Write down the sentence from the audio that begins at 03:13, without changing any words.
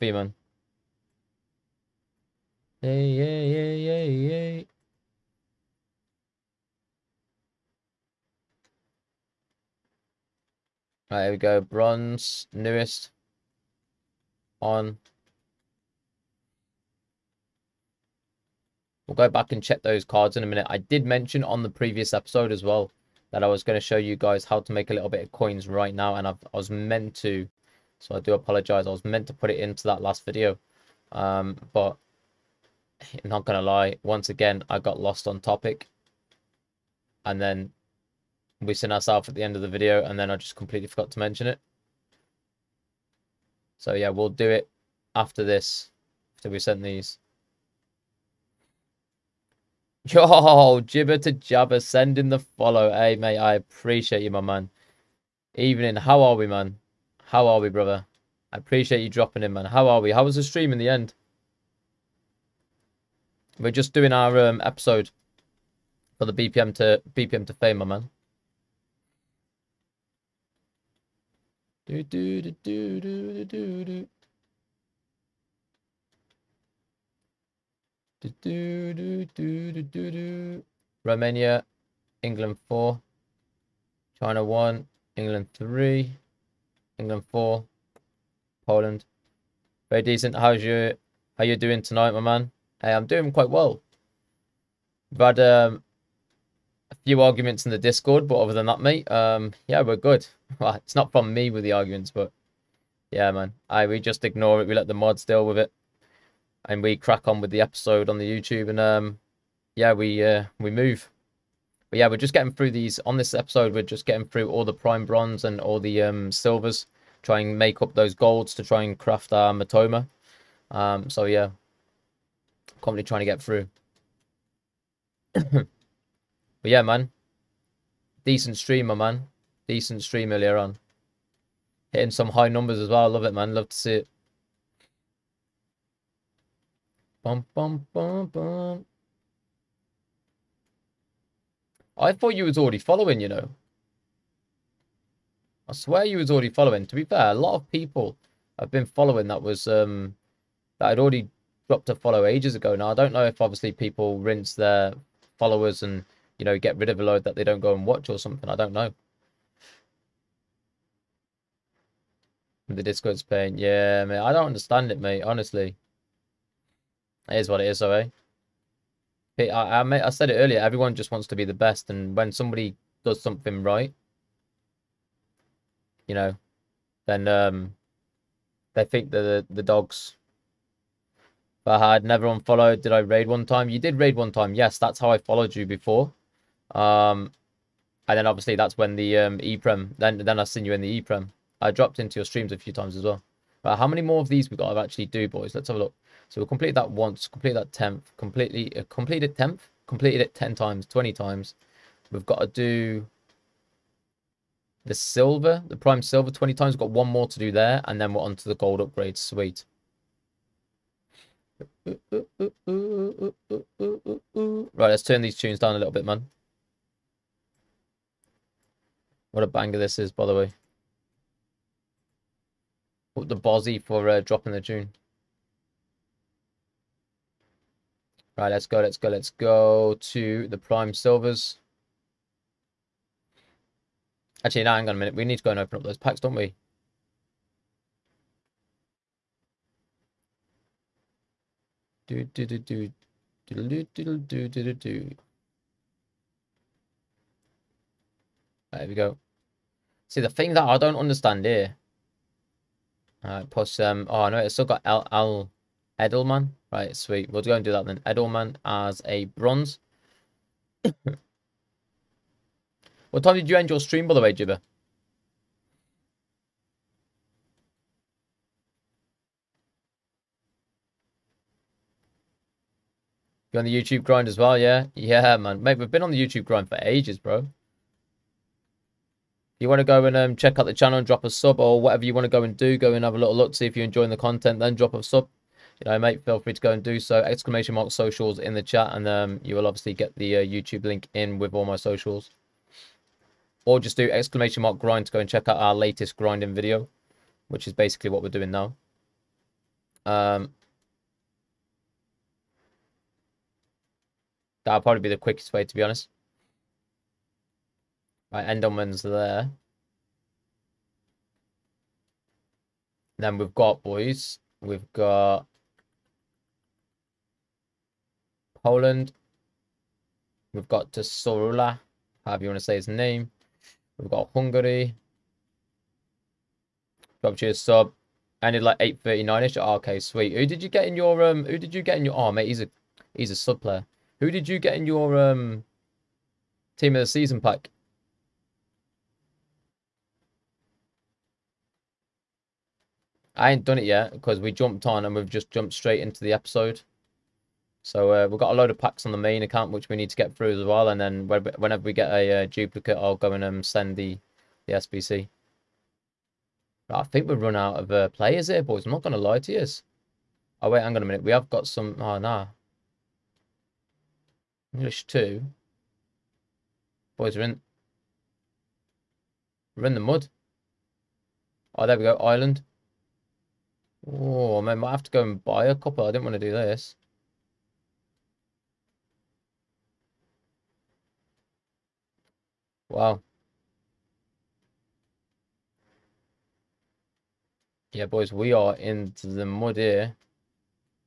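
But how many more of these we got to actually do, boys?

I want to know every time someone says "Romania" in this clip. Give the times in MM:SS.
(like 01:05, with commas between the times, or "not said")
01:21.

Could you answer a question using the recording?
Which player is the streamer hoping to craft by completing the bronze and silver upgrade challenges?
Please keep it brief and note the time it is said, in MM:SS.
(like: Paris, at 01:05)
Mitoma, at 01:59.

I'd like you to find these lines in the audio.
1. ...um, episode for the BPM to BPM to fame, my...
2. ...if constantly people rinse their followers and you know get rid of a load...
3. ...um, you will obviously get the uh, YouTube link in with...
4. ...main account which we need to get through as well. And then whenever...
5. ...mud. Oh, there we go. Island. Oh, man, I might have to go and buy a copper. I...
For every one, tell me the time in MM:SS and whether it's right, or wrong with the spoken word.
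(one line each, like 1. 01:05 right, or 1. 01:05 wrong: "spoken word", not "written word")
1. 01:04 right
2. 02:33 wrong: "obviously", not "constantly"
3. 04:49 right
4. 05:49 right
5. 06:10 right.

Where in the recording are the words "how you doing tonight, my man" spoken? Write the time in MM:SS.
01:31.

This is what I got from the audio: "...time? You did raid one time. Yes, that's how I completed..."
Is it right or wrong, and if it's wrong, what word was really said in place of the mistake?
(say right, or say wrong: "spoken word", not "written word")
wrong: "followed", not "completed".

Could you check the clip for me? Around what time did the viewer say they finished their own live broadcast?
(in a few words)
8.39.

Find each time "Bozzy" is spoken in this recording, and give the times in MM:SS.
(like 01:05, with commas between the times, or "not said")
03:43.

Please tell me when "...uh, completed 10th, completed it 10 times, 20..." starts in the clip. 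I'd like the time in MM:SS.
03:18.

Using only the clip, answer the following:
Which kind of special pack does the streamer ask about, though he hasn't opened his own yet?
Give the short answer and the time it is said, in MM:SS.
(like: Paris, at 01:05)
team of the season, at 05:36.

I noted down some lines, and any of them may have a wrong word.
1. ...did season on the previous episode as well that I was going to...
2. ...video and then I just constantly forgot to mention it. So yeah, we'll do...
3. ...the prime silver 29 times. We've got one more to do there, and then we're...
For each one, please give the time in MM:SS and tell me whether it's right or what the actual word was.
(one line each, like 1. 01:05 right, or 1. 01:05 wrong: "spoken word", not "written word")
1. 00:20 wrong: "mention", not "season"
2. 00:39 wrong: "completely", not "constantly"
3. 03:25 wrong: "20", not "29".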